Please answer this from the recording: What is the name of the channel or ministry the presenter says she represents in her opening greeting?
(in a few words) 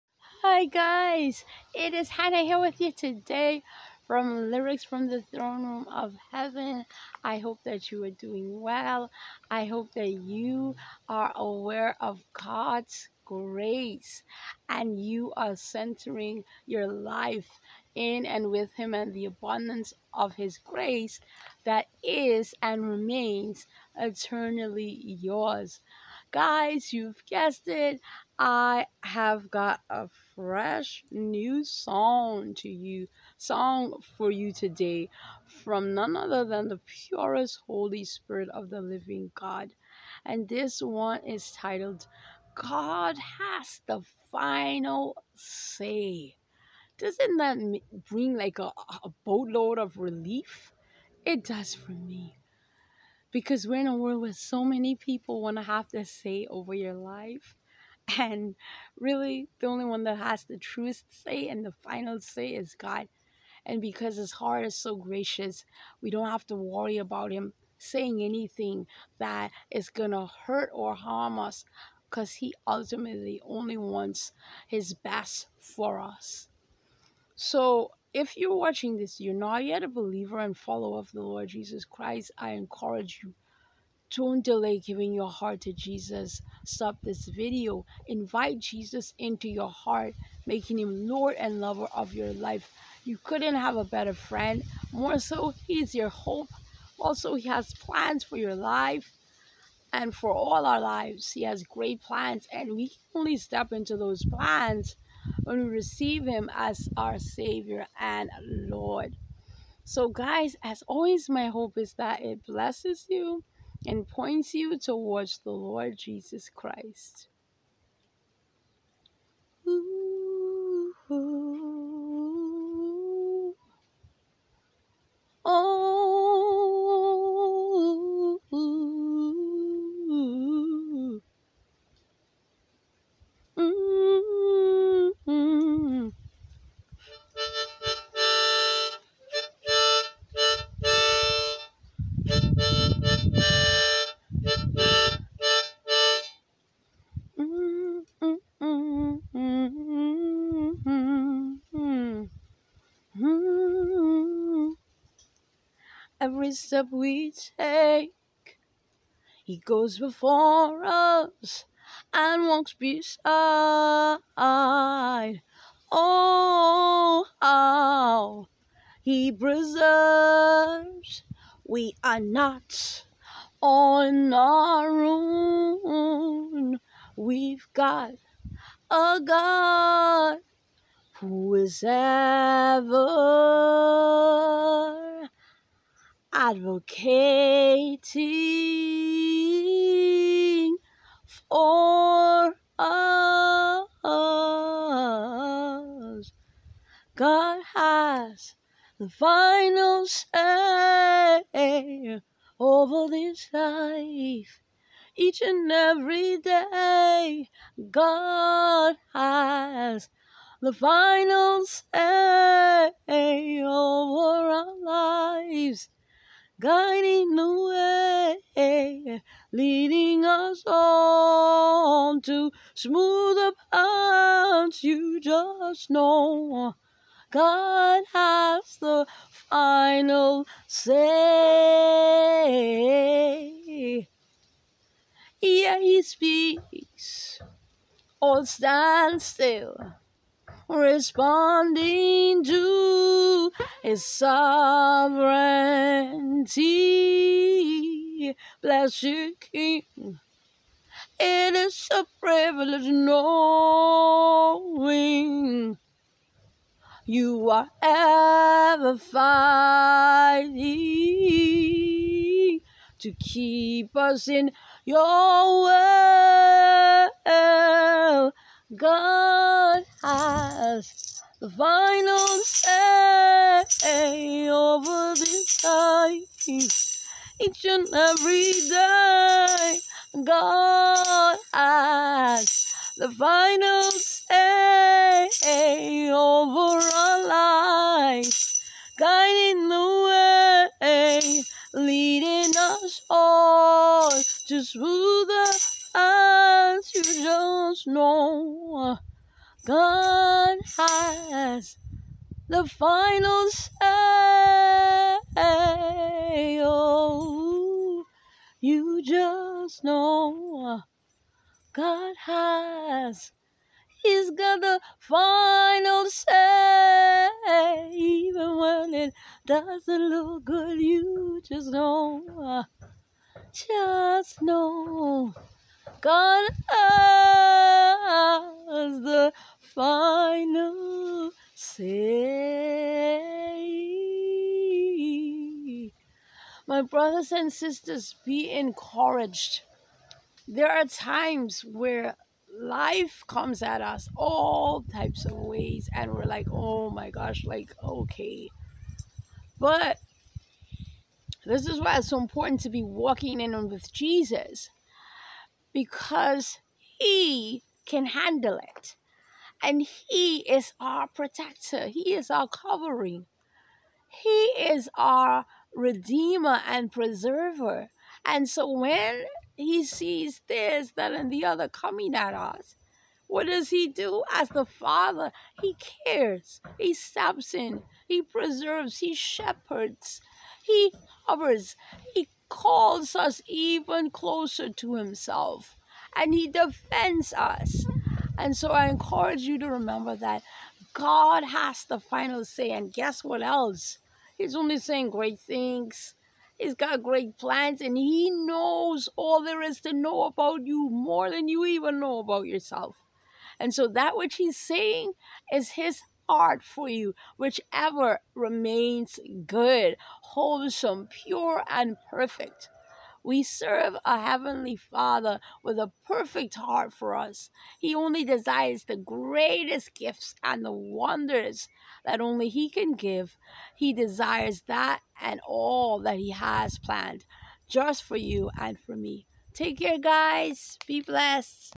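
Lyrics from the Throne Room of Heaven.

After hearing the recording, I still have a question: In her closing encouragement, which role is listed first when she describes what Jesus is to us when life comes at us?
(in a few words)
protector.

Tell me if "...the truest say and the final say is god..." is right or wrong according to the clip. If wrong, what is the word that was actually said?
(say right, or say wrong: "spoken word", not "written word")
right.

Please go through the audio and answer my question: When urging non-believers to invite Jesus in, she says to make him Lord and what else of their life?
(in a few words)
lover.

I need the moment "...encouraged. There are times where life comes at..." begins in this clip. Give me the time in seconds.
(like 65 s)
338 s.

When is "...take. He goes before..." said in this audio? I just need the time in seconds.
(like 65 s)
157 s.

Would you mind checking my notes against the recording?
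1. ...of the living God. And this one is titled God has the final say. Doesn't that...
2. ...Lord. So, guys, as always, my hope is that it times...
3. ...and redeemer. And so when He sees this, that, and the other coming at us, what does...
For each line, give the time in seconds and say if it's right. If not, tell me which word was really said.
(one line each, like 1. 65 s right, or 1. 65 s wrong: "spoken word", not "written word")
1. 38 s right
2. 108 s wrong: "blesses", not "times"
3. 366 s wrong: "preserver", not "redeemer".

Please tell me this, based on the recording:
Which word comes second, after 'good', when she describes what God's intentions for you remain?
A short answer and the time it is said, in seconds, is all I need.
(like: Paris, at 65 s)
wholesome, at 410 s.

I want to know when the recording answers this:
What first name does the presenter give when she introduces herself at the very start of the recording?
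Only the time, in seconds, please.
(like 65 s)
2 s.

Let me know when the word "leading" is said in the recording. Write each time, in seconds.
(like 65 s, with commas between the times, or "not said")
219 s, 291 s.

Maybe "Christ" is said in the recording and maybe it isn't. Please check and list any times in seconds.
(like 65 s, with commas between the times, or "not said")
81 s, 116 s.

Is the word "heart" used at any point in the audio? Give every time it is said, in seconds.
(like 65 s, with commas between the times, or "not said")
64 s, 85 s, 89 s, 406 s, 416 s.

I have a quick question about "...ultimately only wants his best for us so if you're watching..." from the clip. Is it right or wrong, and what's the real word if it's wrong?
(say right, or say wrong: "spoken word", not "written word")
right.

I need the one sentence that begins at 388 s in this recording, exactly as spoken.
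And so I encourage you to remember that God has the final say.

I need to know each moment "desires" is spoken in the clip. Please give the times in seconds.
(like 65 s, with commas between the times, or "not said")
418 s, 423 s.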